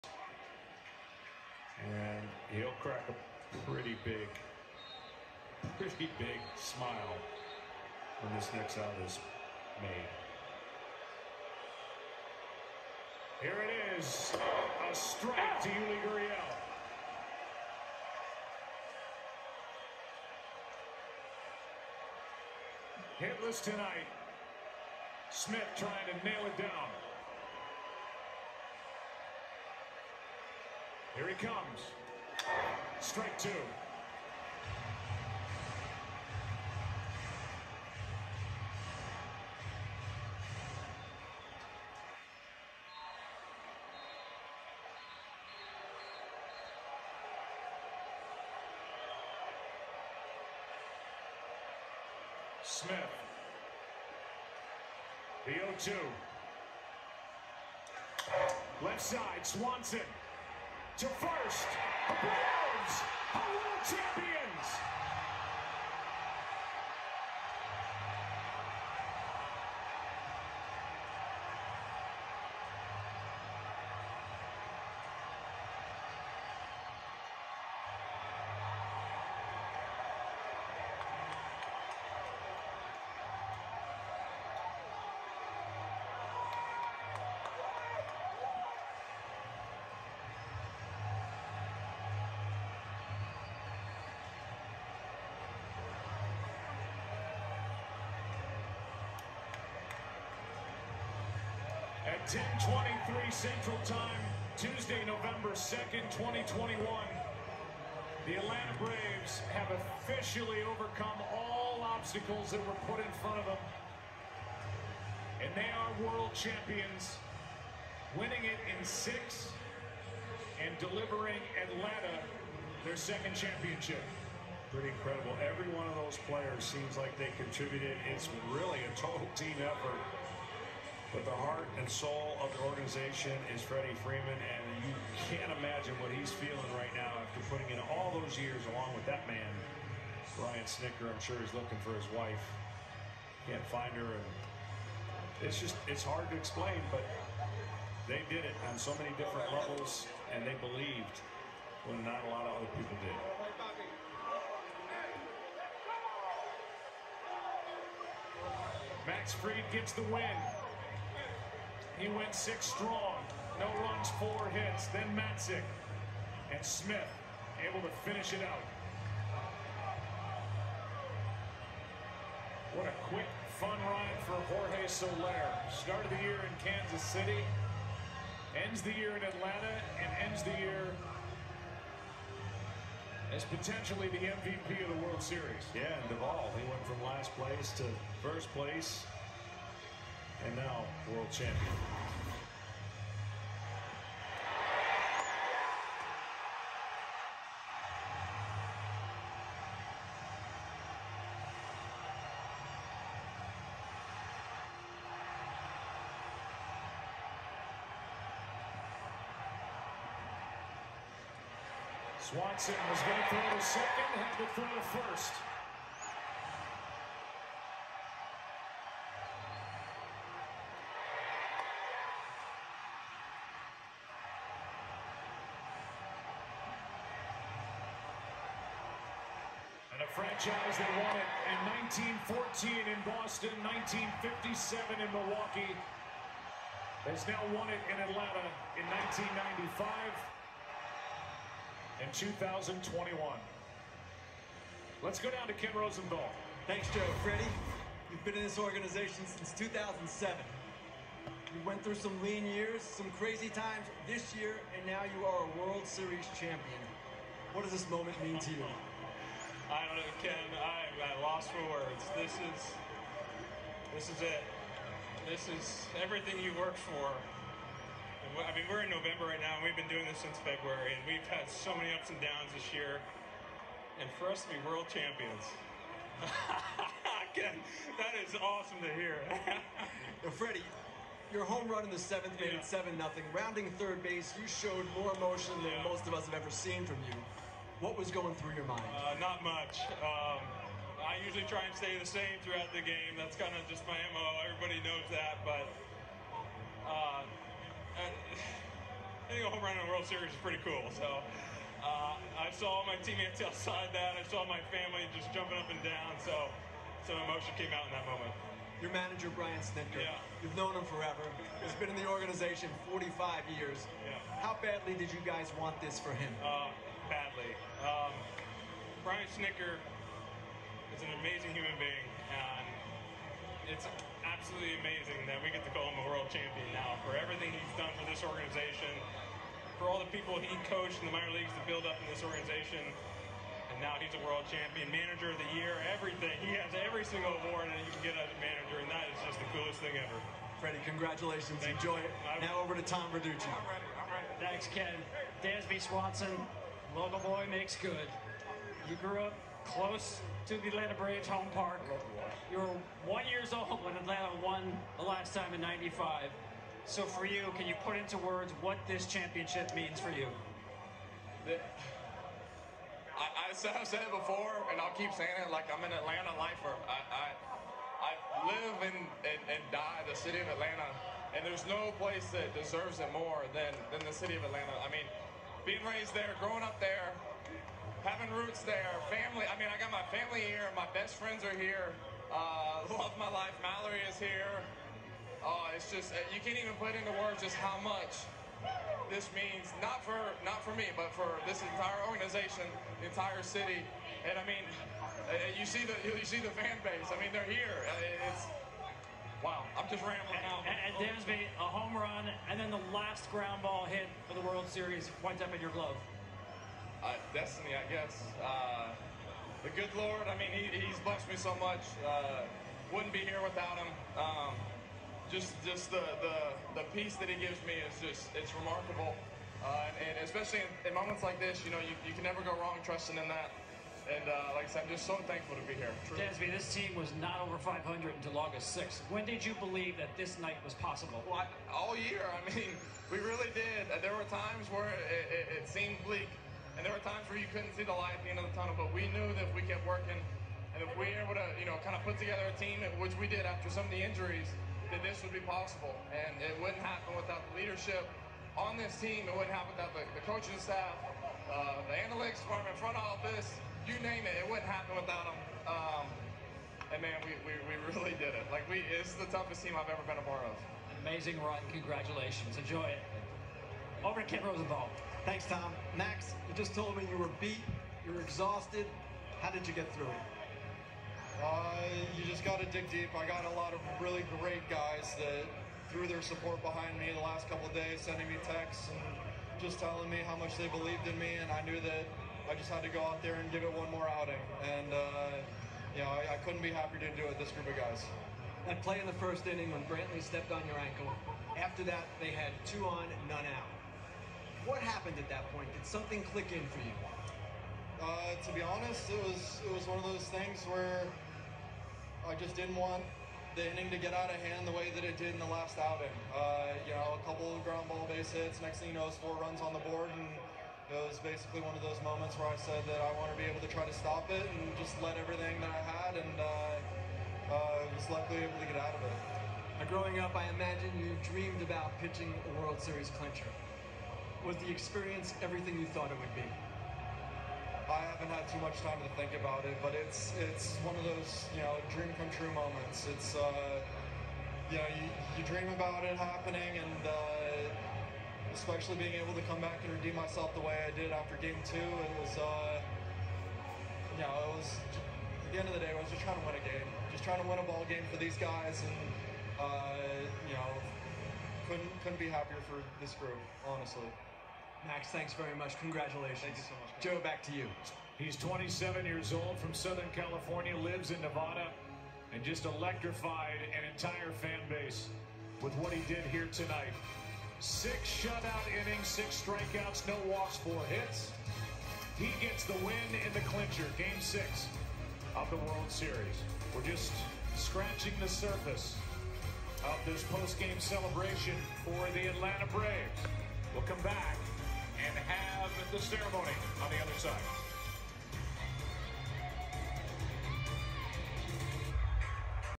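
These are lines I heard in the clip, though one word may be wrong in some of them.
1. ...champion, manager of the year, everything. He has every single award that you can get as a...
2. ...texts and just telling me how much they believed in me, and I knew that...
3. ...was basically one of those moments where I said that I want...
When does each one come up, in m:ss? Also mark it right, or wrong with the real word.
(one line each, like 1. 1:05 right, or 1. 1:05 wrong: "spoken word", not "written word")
1. 5:34 right
2. 7:58 right
3. 8:31 right.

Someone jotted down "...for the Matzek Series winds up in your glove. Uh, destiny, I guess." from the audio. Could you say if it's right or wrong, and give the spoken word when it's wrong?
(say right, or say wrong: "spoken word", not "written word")
wrong: "World", not "Matzek".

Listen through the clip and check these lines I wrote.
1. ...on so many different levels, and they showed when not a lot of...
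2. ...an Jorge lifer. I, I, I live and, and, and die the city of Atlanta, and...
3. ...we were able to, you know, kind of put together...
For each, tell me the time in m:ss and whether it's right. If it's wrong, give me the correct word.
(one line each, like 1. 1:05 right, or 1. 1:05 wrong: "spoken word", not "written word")
1. 2:28 wrong: "believed", not "showed"
2. 6:05 wrong: "Atlanta", not "Jorge"
3. 7:20 right.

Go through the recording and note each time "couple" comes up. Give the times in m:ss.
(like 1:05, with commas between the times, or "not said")
7:57, 8:27.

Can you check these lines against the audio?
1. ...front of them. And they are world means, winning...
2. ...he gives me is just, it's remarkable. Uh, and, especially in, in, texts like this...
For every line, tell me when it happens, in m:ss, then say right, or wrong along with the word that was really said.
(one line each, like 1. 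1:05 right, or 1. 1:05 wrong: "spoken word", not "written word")
1. 1:53 wrong: "champions", not "means"
2. 6:57 wrong: "moments", not "texts".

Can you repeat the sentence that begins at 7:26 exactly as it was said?
And it wouldn't happen without the leadership on this team.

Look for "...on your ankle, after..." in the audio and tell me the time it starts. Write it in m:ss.
8:10.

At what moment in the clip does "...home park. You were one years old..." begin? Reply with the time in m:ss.
5:51.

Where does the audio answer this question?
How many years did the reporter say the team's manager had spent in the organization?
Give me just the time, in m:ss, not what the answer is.
5:12.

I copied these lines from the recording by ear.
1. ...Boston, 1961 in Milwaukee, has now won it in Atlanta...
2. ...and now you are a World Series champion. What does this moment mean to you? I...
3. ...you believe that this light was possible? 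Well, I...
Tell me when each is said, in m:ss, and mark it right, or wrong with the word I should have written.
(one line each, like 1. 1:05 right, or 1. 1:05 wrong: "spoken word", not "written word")
1. 3:53 wrong: "1957", not "1961"
2. 4:14 right
3. 7:09 wrong: "night", not "light".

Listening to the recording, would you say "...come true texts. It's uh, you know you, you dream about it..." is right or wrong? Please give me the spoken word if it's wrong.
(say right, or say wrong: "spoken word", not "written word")
wrong: "moments", not "texts".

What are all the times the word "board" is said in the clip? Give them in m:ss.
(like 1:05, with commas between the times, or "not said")
8:29.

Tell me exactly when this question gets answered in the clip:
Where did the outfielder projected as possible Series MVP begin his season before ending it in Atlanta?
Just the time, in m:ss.
2:56.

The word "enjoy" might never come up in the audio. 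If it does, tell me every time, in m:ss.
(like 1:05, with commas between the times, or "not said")
5:41, 7:42.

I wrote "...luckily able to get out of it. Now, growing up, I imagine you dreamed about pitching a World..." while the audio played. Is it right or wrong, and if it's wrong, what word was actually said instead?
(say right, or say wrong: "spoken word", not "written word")
right.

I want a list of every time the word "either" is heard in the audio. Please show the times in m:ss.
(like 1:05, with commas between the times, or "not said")
not said.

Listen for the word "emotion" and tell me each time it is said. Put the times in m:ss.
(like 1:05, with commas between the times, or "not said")
4:45, 5:07.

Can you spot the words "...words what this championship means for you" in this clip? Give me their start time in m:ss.
5:58.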